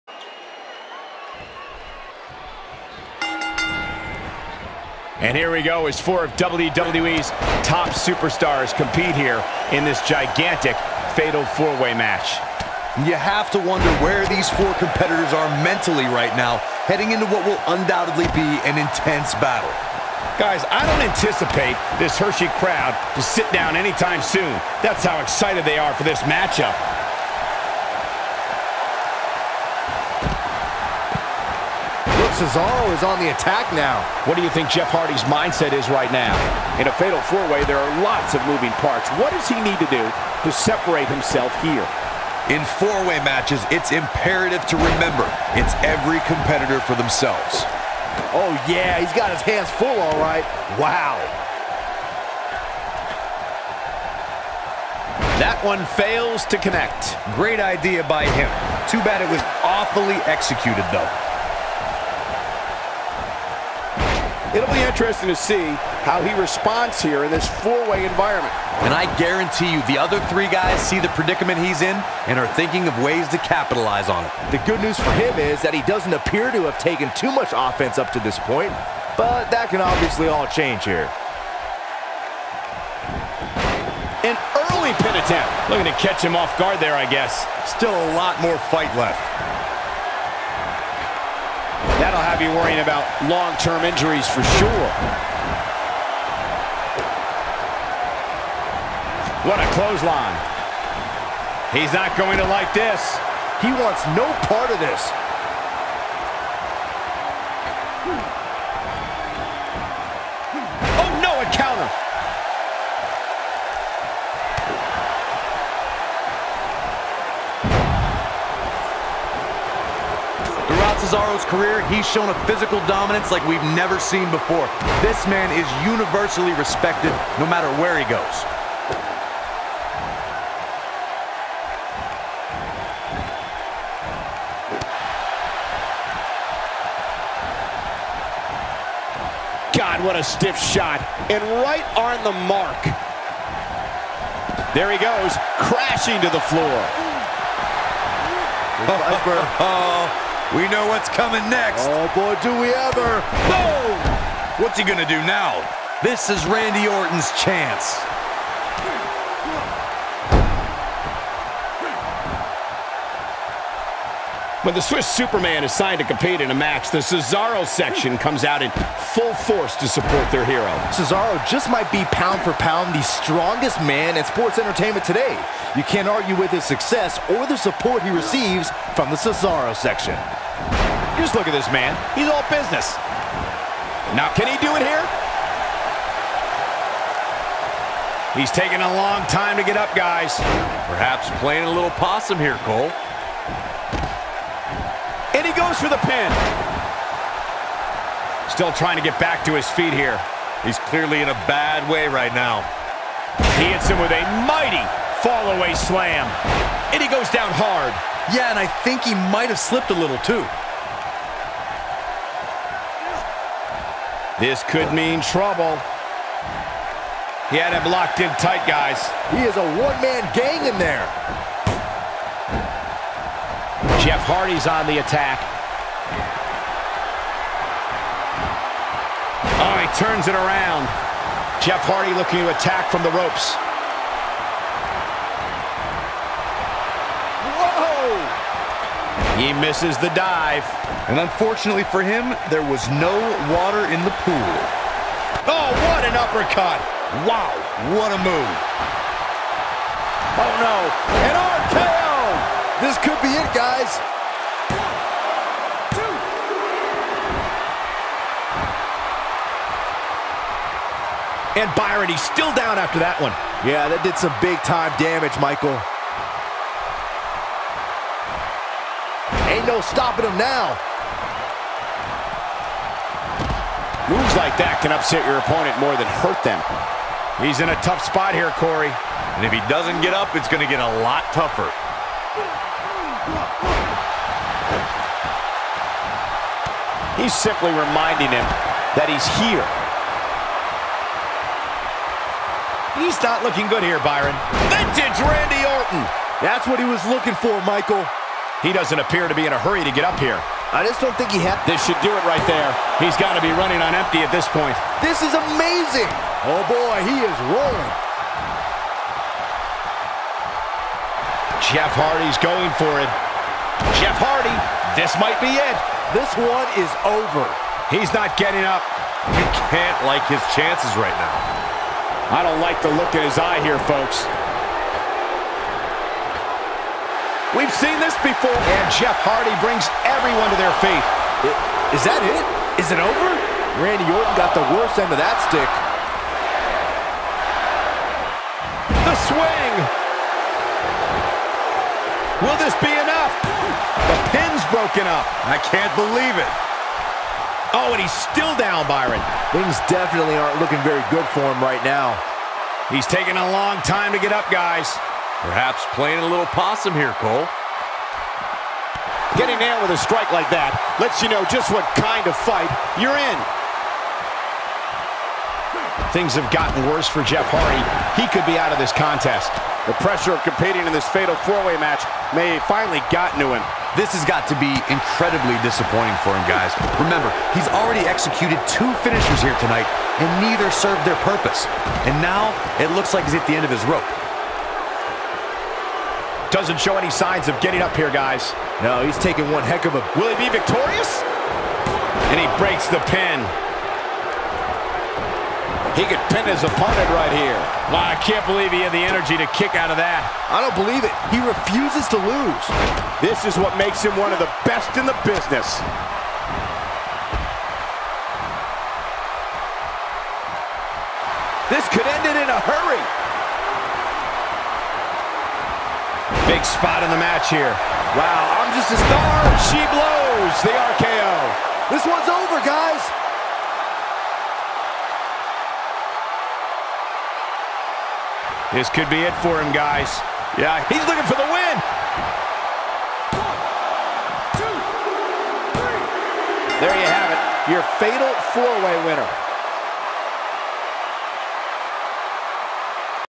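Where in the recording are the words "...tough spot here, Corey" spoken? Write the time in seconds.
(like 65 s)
277 s.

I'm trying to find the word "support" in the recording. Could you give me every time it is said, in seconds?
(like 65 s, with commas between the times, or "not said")
169 s, 177 s.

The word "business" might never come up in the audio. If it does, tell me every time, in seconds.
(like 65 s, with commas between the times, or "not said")
182 s, 405 s.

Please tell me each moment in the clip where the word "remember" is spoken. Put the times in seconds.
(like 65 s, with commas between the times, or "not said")
44 s, 376 s.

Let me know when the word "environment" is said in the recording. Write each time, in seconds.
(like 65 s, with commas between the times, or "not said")
68 s.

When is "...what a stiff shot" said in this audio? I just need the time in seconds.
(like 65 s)
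140 s.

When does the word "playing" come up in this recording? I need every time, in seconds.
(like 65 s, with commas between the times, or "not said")
191 s, 355 s.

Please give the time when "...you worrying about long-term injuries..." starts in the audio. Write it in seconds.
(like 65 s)
92 s.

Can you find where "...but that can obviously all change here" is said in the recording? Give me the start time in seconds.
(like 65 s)
79 s.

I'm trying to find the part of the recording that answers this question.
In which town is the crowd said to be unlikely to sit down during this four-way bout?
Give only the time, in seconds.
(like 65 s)
22 s.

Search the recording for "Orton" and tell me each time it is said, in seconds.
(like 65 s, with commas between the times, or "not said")
156 s, 295 s, 334 s.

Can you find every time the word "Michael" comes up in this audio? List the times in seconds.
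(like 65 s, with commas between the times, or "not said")
265 s, 297 s.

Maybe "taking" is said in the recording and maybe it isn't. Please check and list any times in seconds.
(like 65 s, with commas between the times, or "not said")
188 s, 353 s, 389 s.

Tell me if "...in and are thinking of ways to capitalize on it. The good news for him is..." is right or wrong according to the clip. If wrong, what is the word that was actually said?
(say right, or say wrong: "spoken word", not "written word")
right.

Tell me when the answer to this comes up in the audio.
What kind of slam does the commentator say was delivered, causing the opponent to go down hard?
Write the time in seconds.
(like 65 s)
205 s.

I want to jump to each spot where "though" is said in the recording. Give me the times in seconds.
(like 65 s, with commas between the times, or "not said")
60 s.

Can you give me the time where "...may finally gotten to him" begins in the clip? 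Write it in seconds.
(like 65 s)
372 s.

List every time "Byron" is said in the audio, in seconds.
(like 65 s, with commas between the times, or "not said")
261 s, 294 s, 348 s.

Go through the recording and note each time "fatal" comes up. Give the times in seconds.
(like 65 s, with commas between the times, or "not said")
11 s, 36 s, 371 s, 437 s.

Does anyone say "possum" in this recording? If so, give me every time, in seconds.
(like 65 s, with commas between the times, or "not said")
191 s, 356 s.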